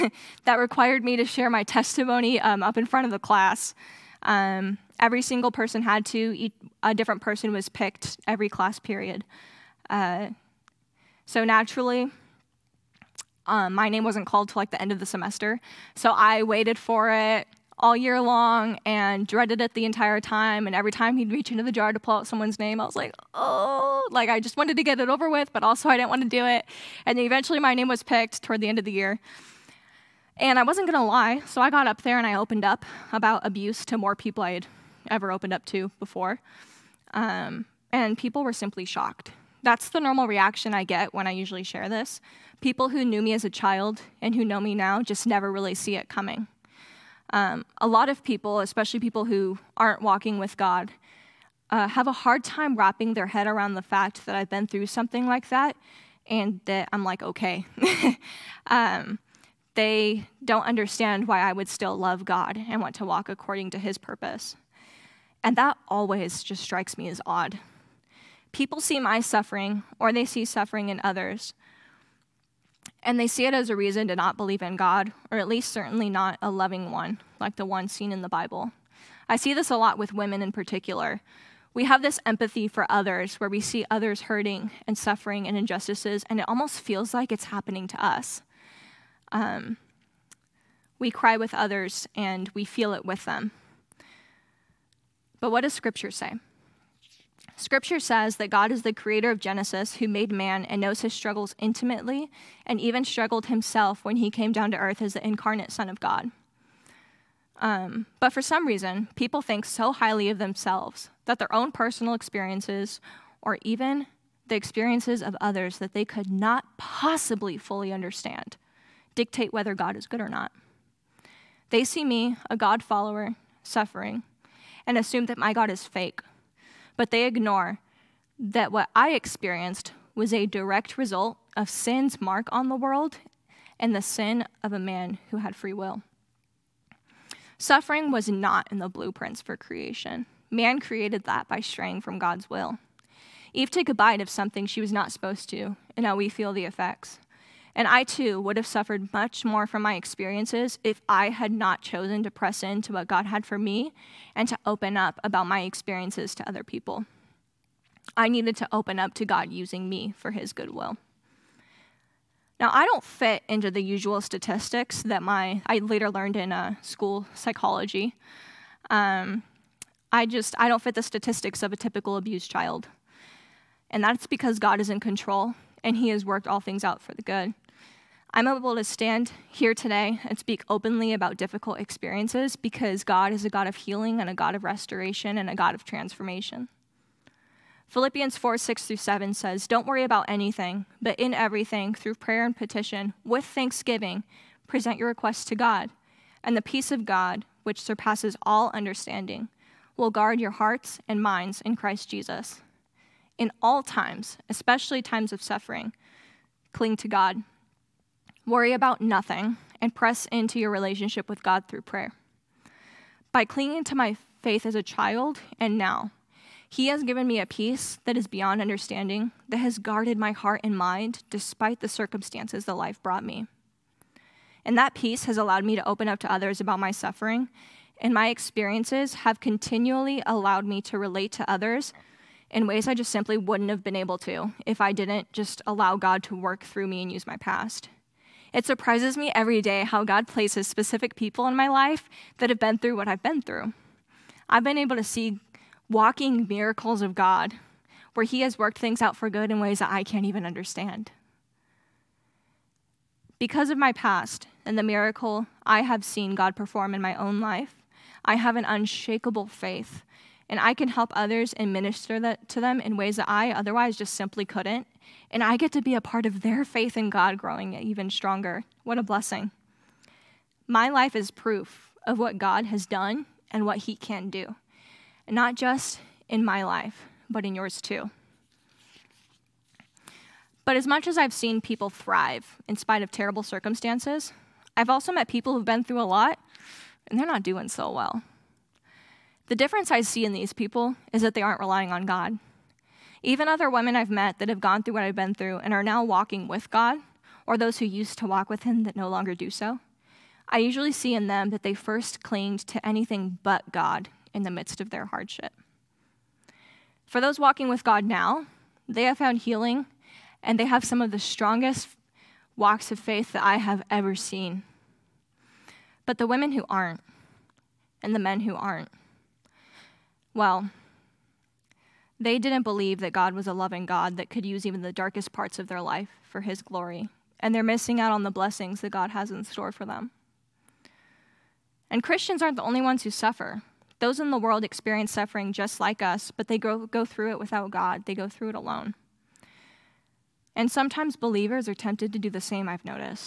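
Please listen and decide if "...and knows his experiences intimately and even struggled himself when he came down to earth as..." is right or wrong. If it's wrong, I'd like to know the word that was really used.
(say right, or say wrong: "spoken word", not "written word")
wrong: "struggles", not "experiences".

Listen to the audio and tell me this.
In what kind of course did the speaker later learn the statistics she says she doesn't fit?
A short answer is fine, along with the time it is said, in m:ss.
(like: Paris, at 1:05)
School psychology, at 2:46.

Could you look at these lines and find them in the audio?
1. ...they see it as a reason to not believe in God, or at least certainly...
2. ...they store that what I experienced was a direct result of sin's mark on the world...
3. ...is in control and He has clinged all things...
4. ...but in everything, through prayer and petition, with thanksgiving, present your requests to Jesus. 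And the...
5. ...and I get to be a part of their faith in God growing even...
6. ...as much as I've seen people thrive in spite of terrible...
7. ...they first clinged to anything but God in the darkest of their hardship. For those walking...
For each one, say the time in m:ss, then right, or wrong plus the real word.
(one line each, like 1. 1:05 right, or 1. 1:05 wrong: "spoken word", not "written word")
1. 1:13 right
2. 2:07 wrong: "ignore", not "store"
3. 2:54 wrong: "worked", not "clinged"
4. 3:11 wrong: "God", not "Jesus"
5. 4:25 right
6. 4:40 right
7. 5:01 wrong: "midst", not "darkest".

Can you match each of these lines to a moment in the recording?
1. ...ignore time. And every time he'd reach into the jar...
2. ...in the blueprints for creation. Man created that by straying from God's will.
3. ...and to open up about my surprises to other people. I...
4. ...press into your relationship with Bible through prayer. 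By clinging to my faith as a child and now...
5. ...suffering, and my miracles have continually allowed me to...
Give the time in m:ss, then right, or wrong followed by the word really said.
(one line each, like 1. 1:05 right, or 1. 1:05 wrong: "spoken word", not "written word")
1. 0:19 wrong: "entire", not "ignore"
2. 2:18 right
3. 2:34 wrong: "experiences", not "surprises"
4. 3:29 wrong: "God", not "Bible"
5. 3:46 wrong: "experiences", not "miracles".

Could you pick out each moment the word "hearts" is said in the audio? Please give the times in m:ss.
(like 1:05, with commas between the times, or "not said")
3:20, 3:40.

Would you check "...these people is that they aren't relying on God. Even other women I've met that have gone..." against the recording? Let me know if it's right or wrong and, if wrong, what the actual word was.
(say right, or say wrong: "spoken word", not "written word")
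right.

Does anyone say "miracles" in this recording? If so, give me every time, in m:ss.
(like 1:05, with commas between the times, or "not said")
4:06, 4:14.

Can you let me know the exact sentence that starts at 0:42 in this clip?
People who knew me as a child and who know me now just never really see it coming.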